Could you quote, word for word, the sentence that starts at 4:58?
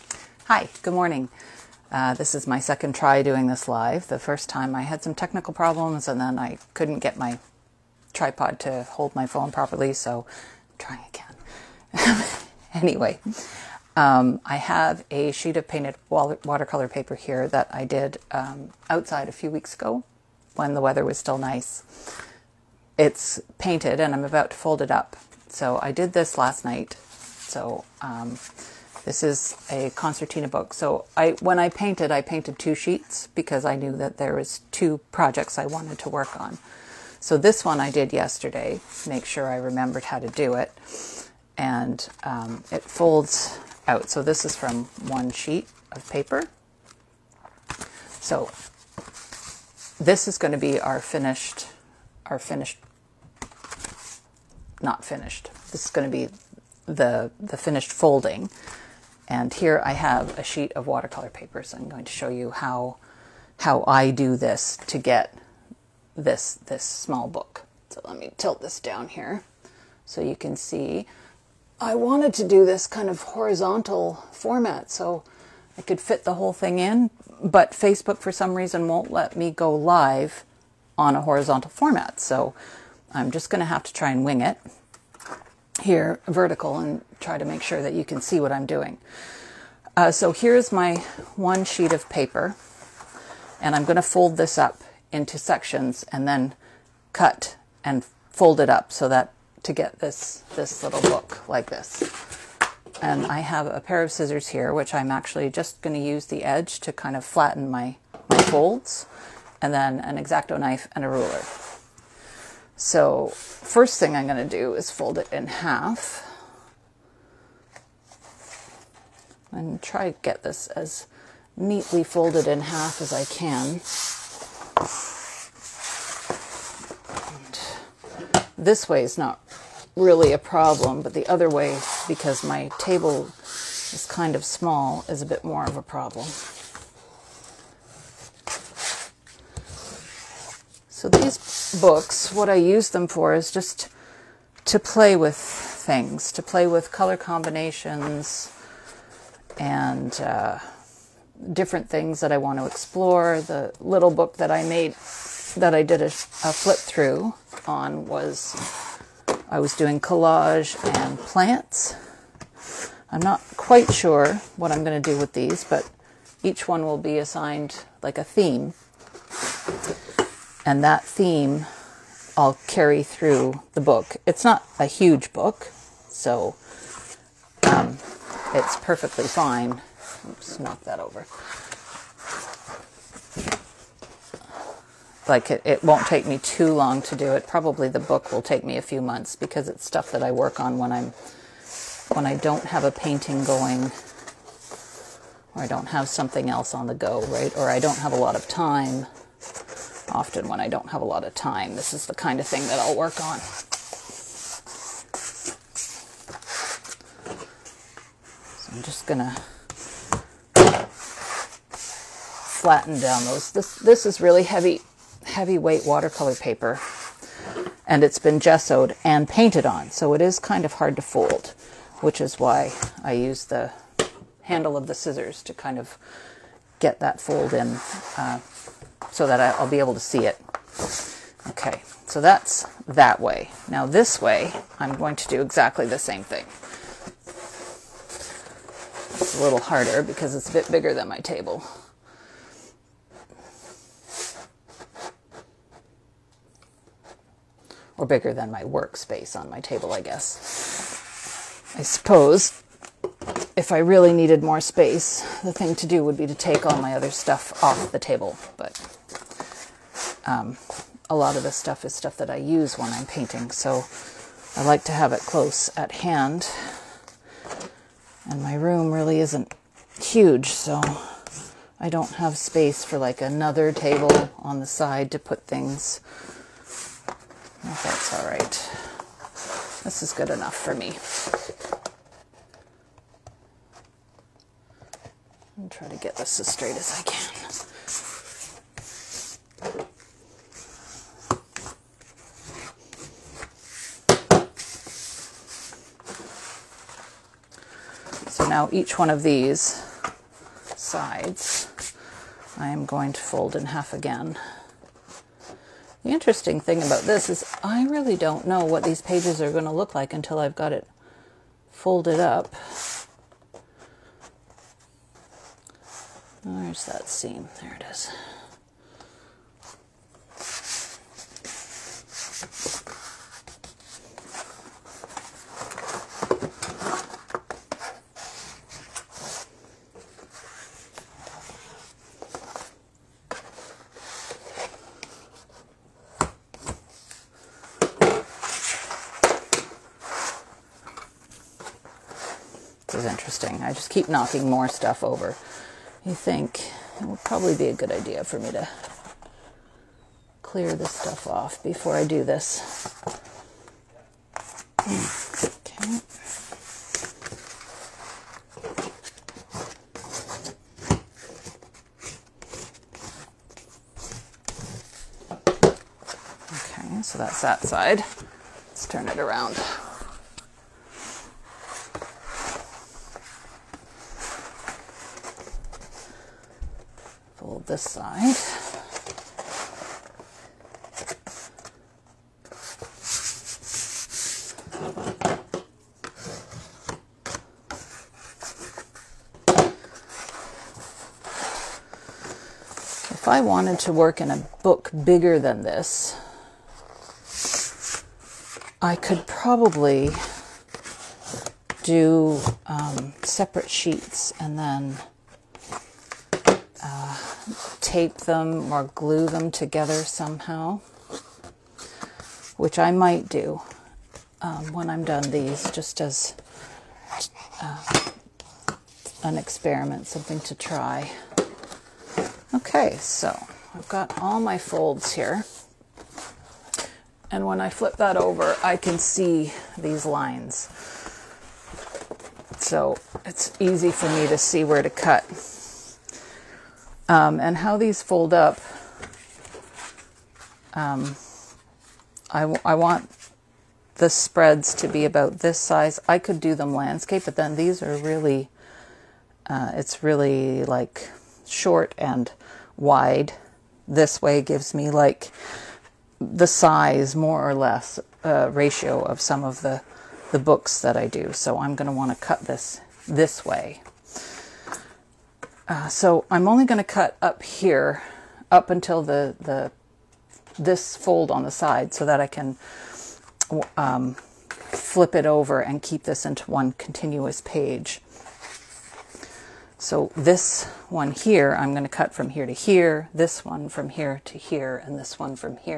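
now each one of these sides I am going to fold in half again.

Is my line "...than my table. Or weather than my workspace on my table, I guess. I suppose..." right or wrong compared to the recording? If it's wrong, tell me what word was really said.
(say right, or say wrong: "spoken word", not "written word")
wrong: "bigger", not "weather".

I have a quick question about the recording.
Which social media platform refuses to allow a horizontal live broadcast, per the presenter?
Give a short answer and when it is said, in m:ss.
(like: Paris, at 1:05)
Facebook, at 1:17.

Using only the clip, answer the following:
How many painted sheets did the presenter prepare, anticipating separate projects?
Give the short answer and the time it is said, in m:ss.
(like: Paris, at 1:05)
2, at 0:32.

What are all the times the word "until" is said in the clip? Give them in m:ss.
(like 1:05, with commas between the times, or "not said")
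5:10, 7:48.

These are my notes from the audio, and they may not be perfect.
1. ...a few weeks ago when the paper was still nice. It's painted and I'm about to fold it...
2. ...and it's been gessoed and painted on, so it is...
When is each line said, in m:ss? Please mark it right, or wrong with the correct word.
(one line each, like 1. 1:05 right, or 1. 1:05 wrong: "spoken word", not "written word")
1. 0:19 wrong: "weather", not "paper"
2. 3:37 right.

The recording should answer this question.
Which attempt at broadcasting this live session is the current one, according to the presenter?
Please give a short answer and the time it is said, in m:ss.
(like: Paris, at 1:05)
second, at 0:02.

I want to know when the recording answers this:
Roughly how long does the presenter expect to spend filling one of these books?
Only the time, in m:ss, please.
3:08.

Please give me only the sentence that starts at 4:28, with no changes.
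And my room really isn't huge, so I don't have space for like another table on the side to put things.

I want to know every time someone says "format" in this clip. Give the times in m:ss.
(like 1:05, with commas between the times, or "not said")
1:14, 1:21.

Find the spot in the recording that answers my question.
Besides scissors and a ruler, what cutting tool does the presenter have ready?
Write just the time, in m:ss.
1:50.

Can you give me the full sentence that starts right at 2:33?
The little book that I made that I did a, a flip through on was I was doing collage and plants.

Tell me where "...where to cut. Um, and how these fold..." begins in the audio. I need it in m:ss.
7:14.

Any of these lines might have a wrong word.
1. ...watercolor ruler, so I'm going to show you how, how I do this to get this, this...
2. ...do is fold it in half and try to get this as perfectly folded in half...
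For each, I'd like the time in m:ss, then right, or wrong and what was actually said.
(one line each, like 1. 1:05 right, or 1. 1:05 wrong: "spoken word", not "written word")
1. 1:00 wrong: "paper", not "ruler"
2. 1:54 wrong: "neatly", not "perfectly".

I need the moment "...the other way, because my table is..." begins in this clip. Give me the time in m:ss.
2:11.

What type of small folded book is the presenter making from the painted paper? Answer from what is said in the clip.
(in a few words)
concertina book.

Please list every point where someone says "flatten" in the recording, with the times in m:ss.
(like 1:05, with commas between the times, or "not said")
1:47, 3:31.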